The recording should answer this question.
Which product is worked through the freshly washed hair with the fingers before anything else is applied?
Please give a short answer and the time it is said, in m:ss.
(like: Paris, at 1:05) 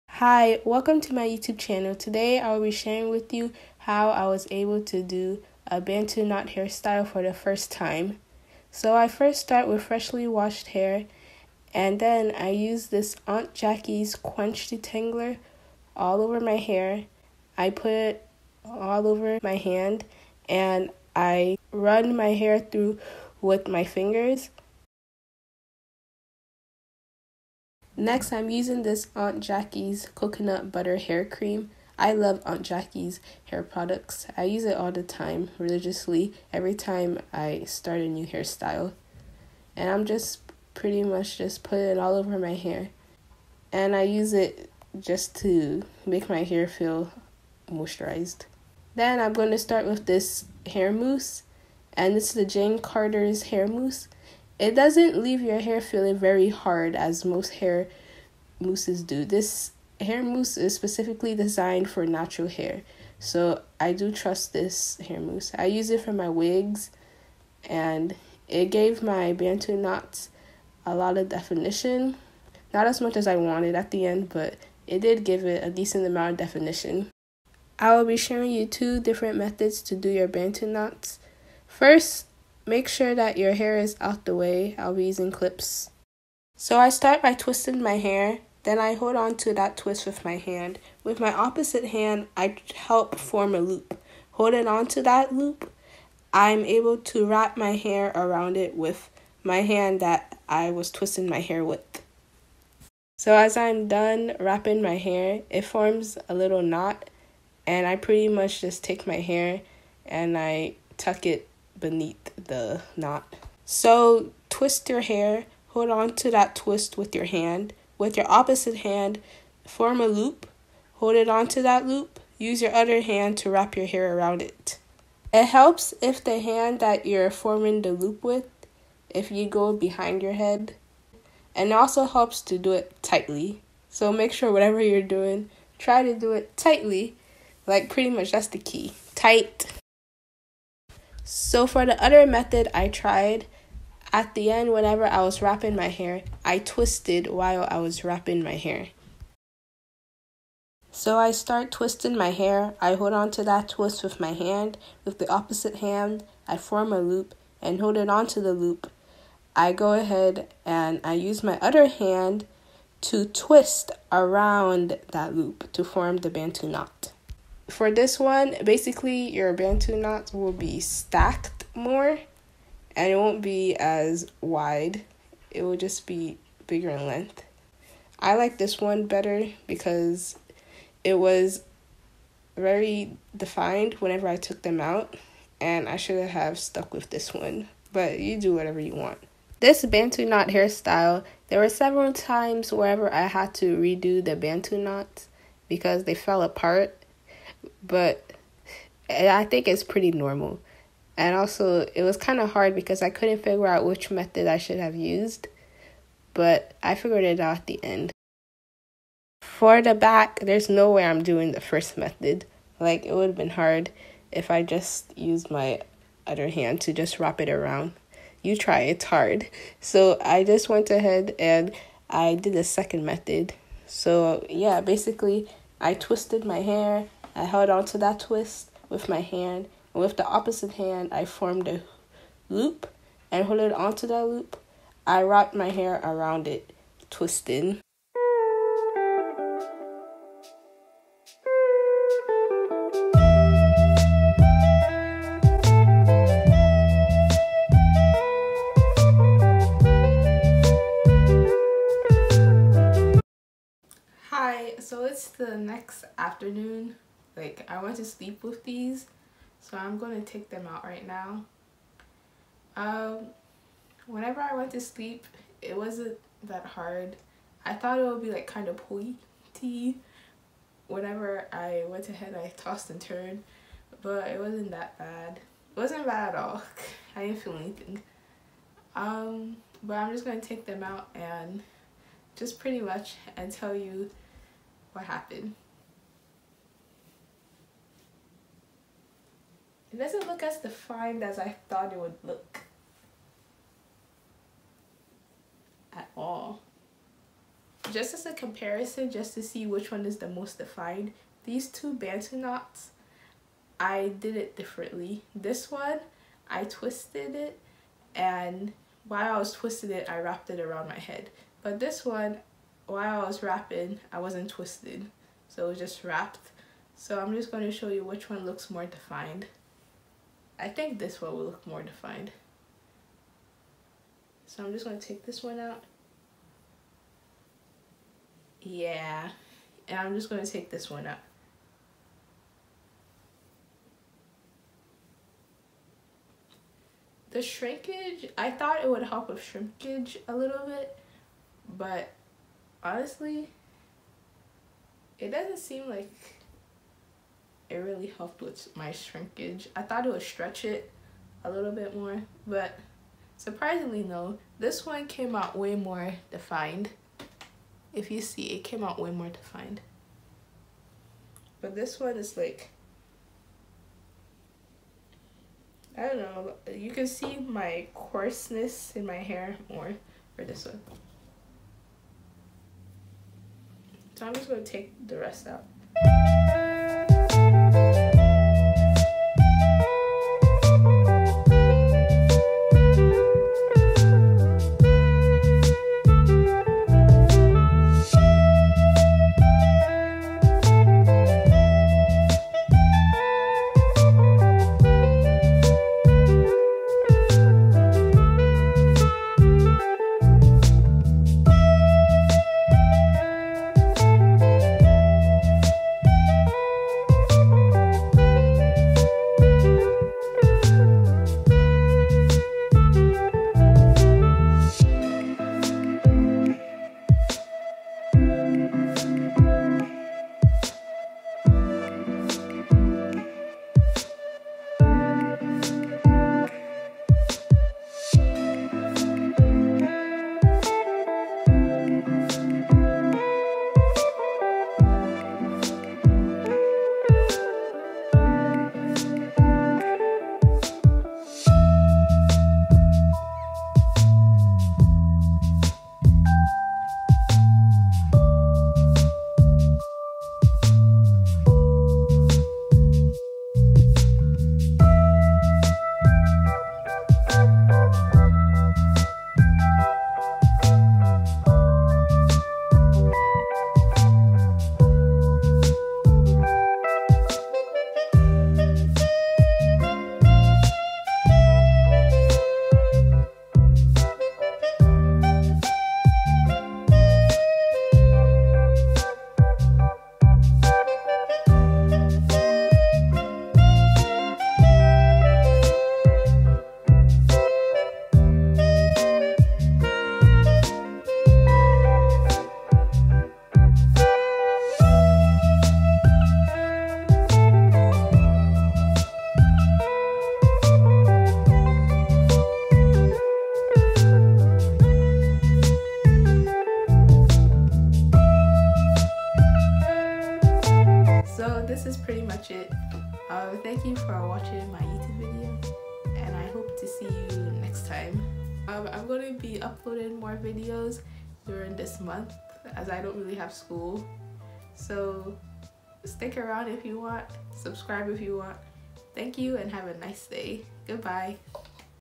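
Aunt Jackie's Quench Detangler, at 0:13.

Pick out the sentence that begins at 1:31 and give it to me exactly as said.
With my opposite hand, I help form a loop.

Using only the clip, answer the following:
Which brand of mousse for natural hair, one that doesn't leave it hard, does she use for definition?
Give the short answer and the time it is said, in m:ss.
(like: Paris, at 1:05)
Jane Carter, at 0:52.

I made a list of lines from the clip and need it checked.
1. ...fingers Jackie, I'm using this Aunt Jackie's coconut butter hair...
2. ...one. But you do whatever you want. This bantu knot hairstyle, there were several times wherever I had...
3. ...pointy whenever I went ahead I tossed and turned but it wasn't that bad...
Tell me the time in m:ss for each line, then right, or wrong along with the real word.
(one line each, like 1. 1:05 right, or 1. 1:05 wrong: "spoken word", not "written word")
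1. 0:23 wrong: "Next", not "Jackie"
2. 3:07 right
3. 4:28 right.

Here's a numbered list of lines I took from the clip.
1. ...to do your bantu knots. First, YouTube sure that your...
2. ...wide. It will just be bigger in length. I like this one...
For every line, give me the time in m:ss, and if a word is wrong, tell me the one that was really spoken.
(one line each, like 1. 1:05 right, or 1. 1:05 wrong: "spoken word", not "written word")
1. 1:19 wrong: "Make", not "YouTube"
2. 2:54 right.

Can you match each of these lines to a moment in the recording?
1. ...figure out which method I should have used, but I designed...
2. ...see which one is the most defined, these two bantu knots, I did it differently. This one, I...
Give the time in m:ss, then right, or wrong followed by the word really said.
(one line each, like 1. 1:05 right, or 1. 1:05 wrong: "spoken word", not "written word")
1. 3:23 wrong: "figured", not "designed"
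2. 4:59 right.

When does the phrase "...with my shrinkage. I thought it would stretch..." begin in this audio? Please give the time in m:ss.
5:48.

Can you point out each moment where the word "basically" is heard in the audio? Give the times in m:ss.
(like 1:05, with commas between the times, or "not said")
2:48, 3:44.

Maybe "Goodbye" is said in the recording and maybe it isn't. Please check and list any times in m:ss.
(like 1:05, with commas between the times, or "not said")
8:50.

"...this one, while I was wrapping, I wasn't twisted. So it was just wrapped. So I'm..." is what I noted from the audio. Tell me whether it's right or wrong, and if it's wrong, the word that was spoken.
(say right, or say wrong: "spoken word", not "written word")
right.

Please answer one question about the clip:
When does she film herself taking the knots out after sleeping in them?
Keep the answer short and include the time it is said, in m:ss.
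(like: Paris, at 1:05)
the next afternoon, at 4:15.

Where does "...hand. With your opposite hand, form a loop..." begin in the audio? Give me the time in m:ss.
1:57.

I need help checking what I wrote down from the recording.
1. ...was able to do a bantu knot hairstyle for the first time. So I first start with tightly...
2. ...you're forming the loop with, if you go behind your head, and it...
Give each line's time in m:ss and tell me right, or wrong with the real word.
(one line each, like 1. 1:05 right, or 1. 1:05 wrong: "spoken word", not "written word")
1. 0:04 wrong: "freshly", not "tightly"
2. 2:07 right.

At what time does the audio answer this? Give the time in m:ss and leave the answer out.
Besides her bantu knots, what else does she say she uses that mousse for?
1:06.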